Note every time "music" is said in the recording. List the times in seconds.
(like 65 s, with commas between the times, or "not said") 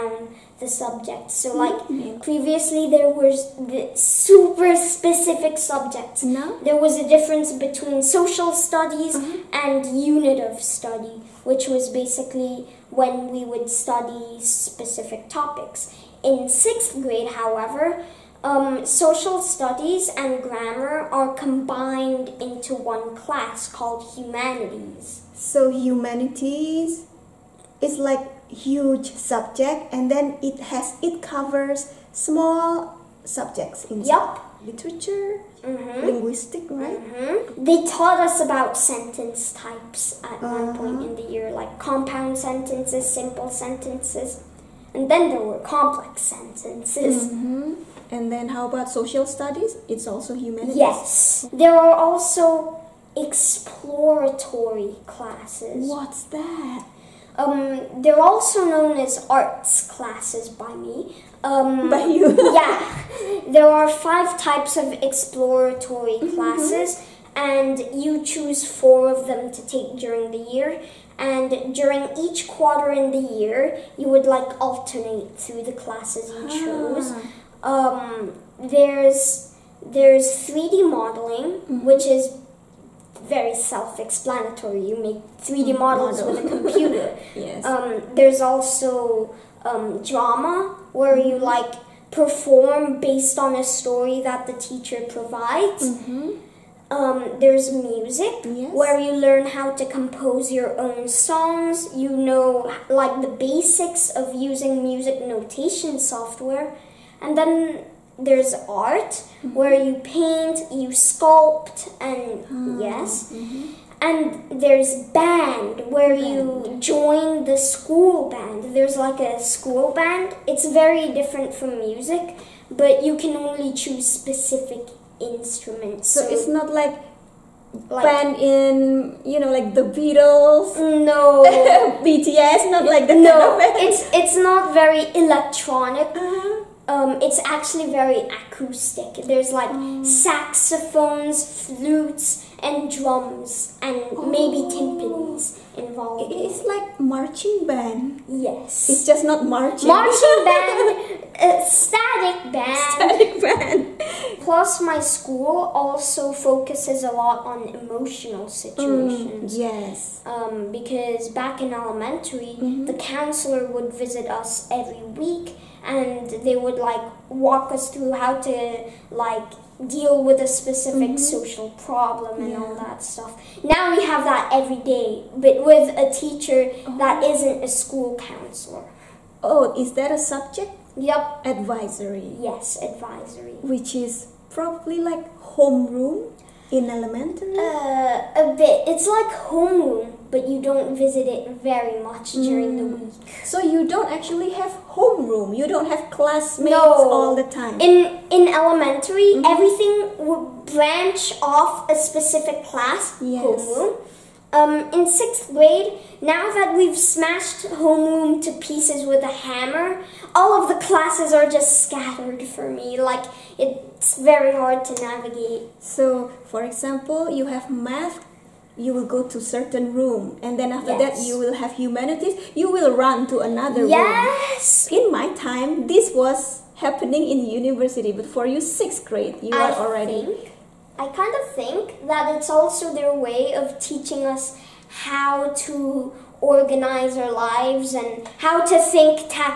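97 s, 104 s, 121 s.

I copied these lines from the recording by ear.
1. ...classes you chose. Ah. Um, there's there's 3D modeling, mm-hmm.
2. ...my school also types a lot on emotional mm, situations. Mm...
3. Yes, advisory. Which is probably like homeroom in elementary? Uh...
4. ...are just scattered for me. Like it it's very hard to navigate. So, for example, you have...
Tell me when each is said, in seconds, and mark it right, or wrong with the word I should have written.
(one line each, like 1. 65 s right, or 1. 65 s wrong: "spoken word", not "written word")
1. 75 s right
2. 154 s wrong: "focuses", not "types"
3. 182 s right
4. 211 s right.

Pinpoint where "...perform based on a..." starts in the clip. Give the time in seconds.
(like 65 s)
92 s.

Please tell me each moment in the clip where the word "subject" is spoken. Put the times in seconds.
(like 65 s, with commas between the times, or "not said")
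0 s, 5 s, 29 s, 33 s, 180 s.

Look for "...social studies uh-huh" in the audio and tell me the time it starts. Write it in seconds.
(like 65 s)
8 s.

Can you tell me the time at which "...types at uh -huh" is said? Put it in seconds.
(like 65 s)
39 s.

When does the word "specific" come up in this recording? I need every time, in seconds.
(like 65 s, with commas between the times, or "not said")
4 s, 14 s, 124 s, 170 s, 202 s.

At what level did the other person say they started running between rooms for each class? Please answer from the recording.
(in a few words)
university.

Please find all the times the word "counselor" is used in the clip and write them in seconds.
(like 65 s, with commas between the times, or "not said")
162 s, 178 s.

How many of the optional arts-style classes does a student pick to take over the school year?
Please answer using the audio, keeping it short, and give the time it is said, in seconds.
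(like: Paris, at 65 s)
4, at 68 s.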